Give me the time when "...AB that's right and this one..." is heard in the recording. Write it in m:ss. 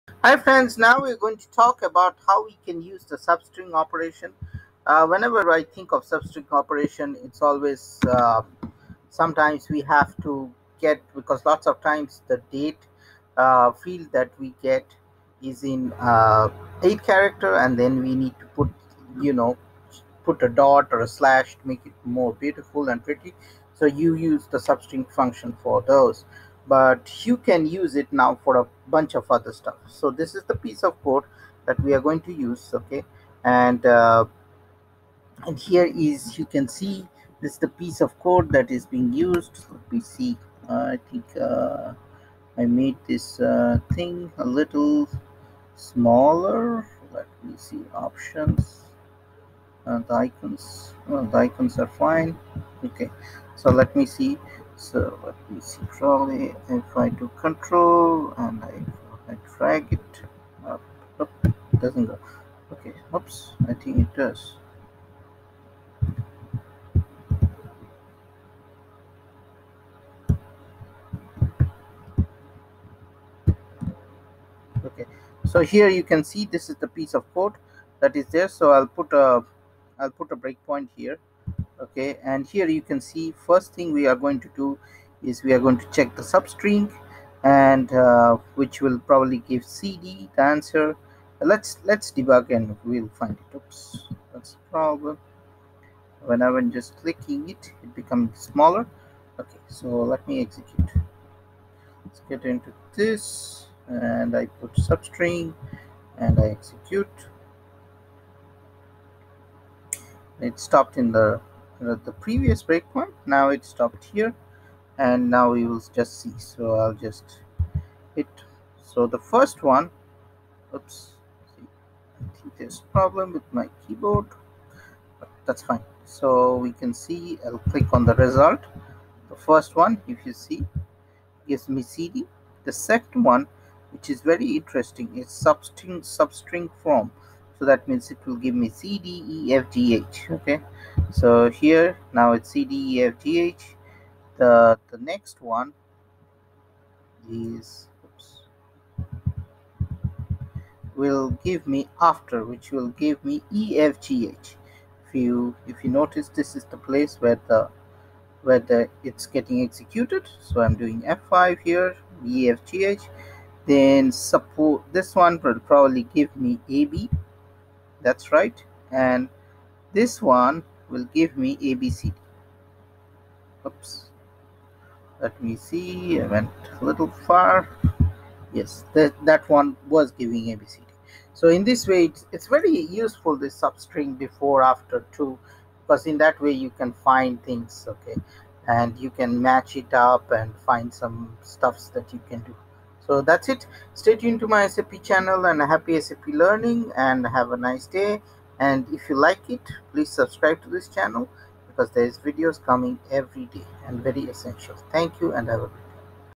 2:46.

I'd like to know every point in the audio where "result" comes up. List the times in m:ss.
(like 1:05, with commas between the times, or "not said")
2:08.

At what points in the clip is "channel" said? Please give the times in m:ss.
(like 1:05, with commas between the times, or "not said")
3:15, 3:20.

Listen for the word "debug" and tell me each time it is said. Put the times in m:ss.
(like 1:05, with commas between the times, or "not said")
1:32.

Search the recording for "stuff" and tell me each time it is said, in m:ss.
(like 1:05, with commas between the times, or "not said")
0:29, 3:11.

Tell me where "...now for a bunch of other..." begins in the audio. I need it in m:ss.
0:28.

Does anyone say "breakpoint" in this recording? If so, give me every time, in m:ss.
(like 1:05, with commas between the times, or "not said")
1:20, 1:52.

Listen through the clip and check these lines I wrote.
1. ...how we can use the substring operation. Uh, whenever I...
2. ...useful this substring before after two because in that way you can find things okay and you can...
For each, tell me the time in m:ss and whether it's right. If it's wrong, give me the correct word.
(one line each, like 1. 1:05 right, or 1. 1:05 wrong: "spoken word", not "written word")
1. 0:02 right
2. 3:02 right.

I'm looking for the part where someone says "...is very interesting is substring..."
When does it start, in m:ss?
2:14.